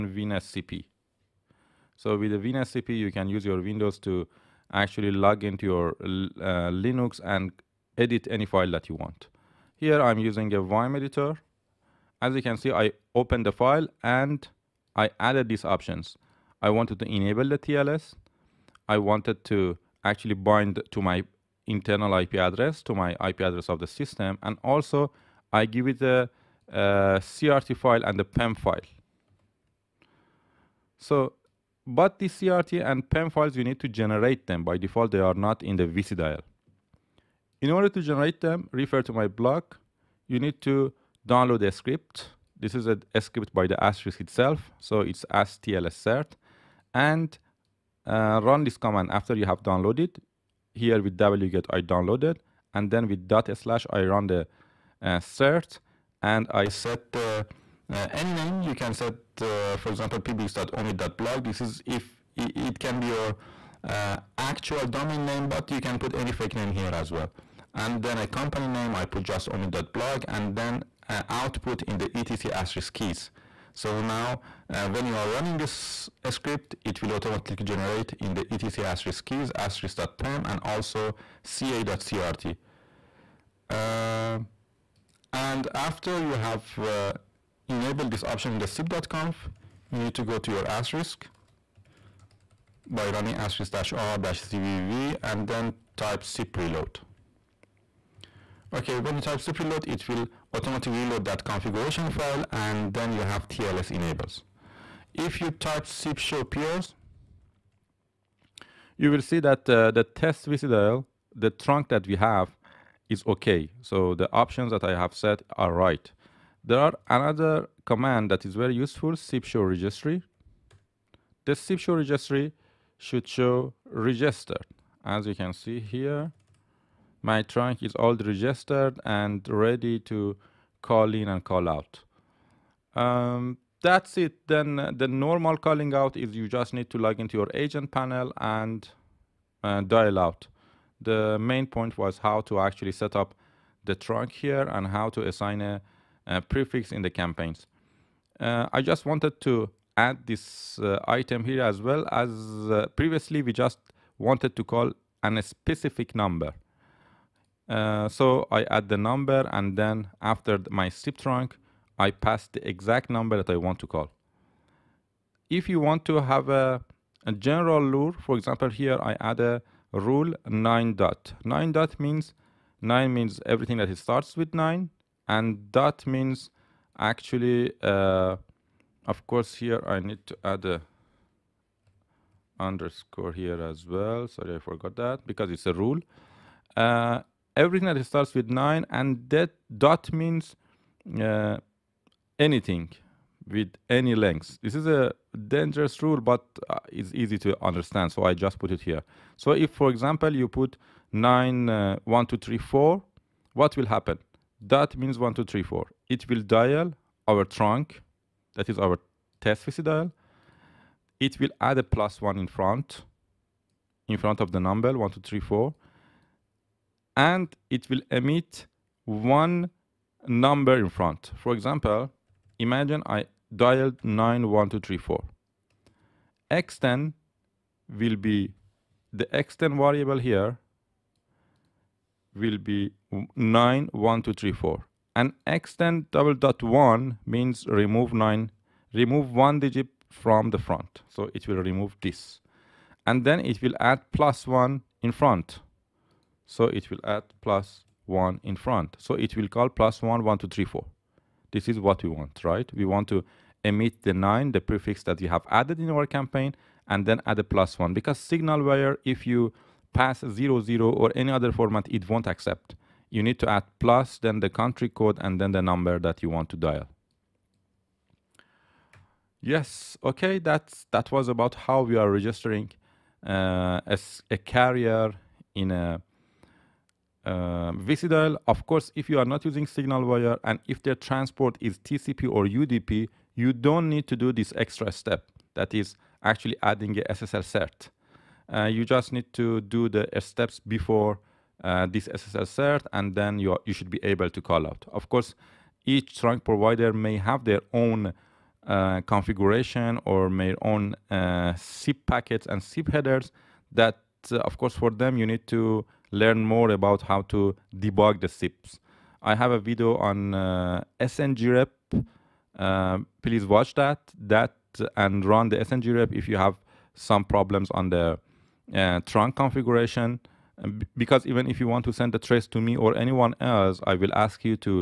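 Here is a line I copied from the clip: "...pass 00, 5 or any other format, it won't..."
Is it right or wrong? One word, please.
wrong.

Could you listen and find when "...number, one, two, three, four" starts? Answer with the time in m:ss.
3:34.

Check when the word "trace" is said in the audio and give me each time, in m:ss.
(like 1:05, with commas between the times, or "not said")
5:22.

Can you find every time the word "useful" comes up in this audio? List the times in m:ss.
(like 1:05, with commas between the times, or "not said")
1:58.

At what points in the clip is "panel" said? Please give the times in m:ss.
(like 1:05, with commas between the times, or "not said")
2:17.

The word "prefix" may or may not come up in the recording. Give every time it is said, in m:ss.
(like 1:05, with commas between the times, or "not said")
2:26, 4:14.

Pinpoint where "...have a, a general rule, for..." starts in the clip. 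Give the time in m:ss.
2:46.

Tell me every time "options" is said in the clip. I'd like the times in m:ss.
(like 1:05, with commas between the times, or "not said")
0:15, 1:28, 1:54.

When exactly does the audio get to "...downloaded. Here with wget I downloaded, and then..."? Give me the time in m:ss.
0:49.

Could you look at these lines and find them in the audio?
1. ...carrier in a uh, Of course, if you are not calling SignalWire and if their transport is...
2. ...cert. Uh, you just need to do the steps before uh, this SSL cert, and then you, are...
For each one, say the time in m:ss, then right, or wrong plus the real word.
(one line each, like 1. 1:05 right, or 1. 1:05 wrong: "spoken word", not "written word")
1. 4:34 wrong: "using", not "calling"
2. 4:47 right.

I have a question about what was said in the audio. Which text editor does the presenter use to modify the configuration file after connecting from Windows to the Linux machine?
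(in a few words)
Vim.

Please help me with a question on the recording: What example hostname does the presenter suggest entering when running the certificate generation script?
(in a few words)
pbx.omit.blog.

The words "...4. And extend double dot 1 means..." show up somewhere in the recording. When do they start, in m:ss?
3:54.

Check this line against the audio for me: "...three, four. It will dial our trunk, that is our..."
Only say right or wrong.
right.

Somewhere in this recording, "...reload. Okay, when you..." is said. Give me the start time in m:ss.
1:36.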